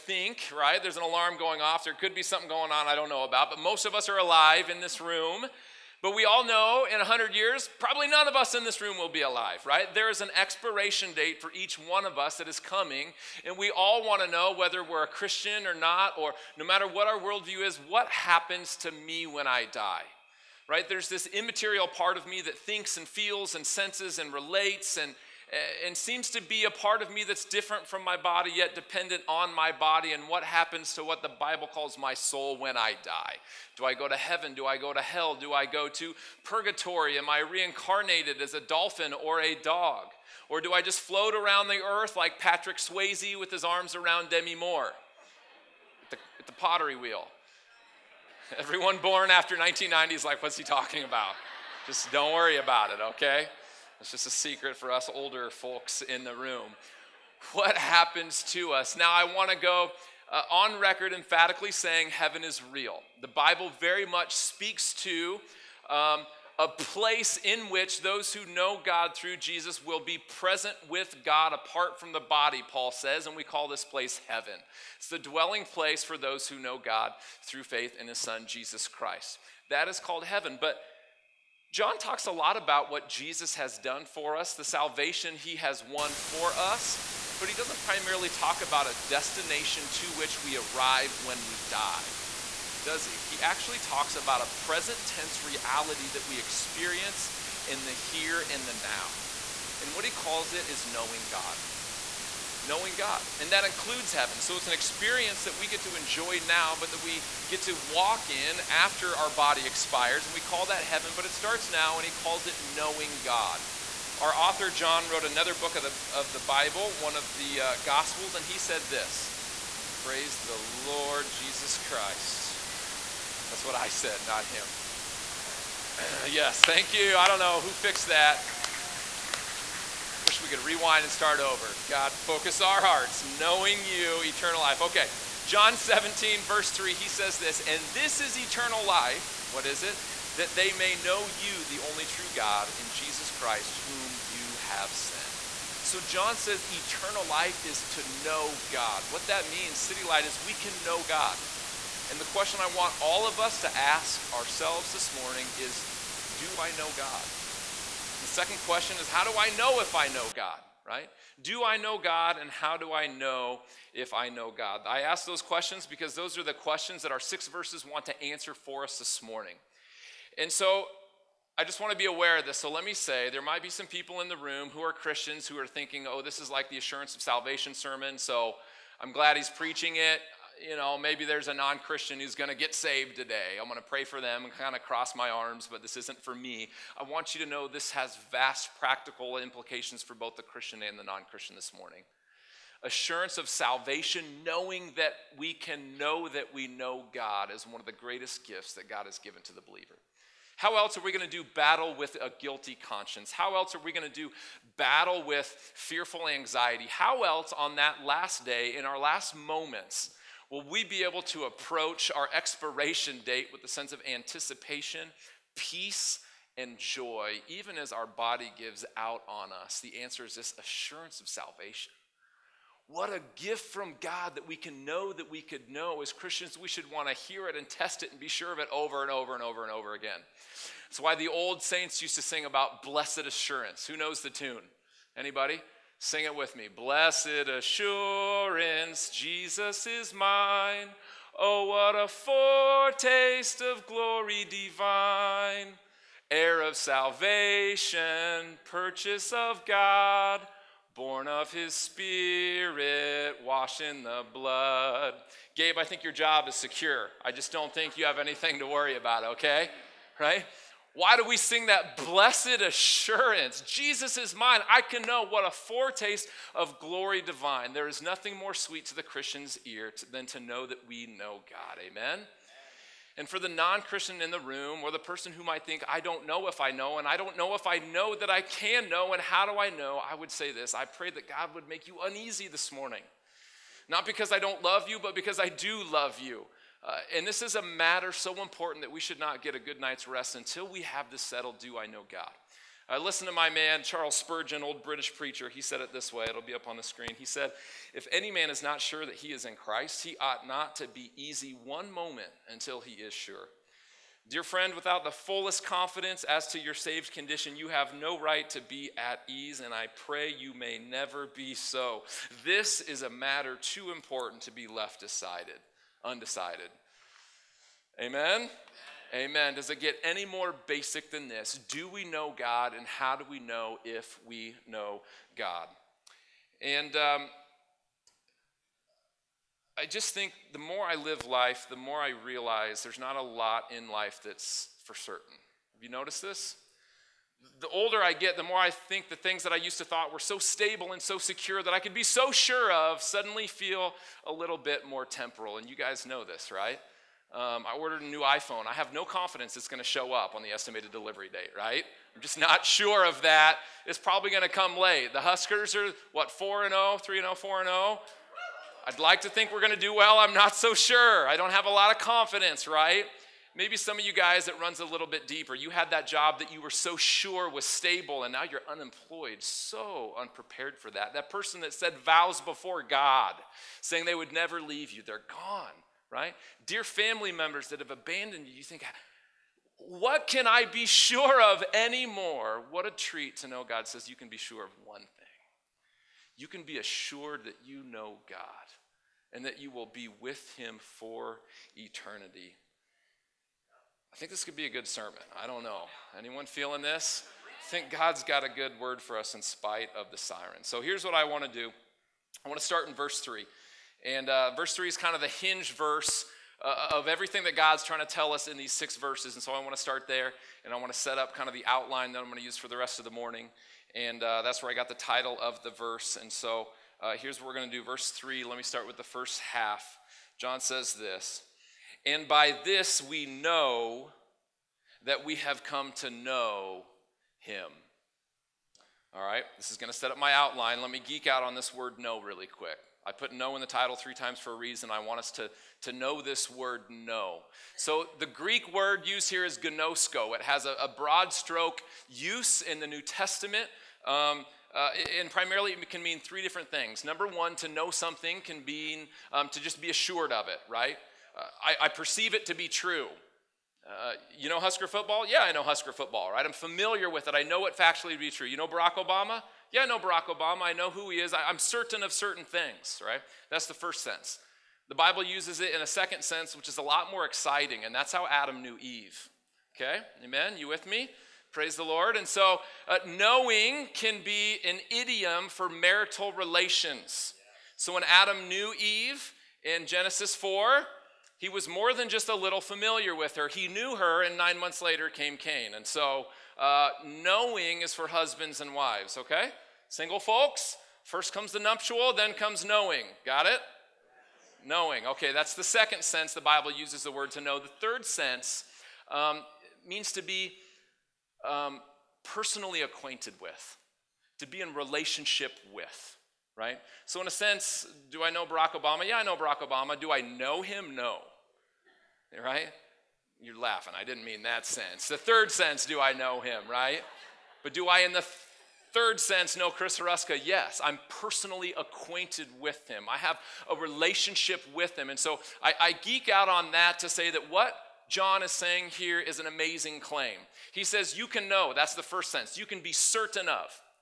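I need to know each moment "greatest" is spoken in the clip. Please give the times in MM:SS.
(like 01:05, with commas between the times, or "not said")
03:17.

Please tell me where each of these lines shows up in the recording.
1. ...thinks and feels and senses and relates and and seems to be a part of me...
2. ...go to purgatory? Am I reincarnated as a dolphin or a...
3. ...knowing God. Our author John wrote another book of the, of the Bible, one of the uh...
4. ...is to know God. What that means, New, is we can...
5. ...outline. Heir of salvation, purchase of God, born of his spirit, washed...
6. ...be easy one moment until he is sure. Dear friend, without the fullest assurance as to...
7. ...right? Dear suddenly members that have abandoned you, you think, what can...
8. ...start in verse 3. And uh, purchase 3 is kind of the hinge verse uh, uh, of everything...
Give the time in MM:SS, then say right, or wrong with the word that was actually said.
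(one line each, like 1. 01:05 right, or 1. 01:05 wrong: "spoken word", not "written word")
1. 00:22 right
2. 00:35 right
3. 01:52 right
4. 02:27 wrong: "Citylight", not "New"
5. 04:04 wrong: "divine", not "outline"
6. 05:00 wrong: "confidence", not "assurance"
7. 06:16 wrong: "family", not "suddenly"
8. 06:42 wrong: "verse", not "purchase".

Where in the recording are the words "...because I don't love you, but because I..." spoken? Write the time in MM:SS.
04:44.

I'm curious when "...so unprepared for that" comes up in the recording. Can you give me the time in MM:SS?
06:09.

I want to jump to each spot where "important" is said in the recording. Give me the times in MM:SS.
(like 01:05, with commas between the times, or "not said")
04:48, 05:13.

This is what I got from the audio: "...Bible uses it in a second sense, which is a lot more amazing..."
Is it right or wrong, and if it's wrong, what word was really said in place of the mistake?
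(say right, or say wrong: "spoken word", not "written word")
wrong: "exciting", not "amazing".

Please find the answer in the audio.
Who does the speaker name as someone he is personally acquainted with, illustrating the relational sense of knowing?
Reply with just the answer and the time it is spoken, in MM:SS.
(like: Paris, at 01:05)
Chris Haruska, at 08:39.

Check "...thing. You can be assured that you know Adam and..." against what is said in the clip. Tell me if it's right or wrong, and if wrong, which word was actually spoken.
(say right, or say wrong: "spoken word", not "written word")
wrong: "God", not "Adam".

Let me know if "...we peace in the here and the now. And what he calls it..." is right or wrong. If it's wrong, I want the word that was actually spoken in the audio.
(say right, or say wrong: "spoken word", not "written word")
wrong: "experience", not "peace".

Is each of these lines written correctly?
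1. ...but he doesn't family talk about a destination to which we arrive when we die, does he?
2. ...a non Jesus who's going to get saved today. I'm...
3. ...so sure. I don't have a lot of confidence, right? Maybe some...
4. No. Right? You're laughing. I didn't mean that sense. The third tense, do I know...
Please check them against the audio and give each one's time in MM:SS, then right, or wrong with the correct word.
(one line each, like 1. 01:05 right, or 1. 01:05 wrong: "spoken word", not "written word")
1. 01:27 wrong: "primarily", not "family"
2. 03:01 wrong: "Christian", not "Jesus"
3. 06:00 right
4. 08:30 wrong: "sense", not "tense".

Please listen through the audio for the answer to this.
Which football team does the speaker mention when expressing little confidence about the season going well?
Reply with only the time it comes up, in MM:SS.
05:55.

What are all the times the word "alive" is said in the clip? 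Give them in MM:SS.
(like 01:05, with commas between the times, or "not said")
00:04, 00:09.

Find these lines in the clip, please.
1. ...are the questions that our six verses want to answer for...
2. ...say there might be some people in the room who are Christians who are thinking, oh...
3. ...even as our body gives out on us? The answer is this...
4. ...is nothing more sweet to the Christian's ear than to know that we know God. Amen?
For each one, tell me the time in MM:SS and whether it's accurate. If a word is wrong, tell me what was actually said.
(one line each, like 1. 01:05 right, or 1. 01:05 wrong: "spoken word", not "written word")
1. 02:46 right
2. 02:52 right
3. 03:37 right
4. 04:27 right.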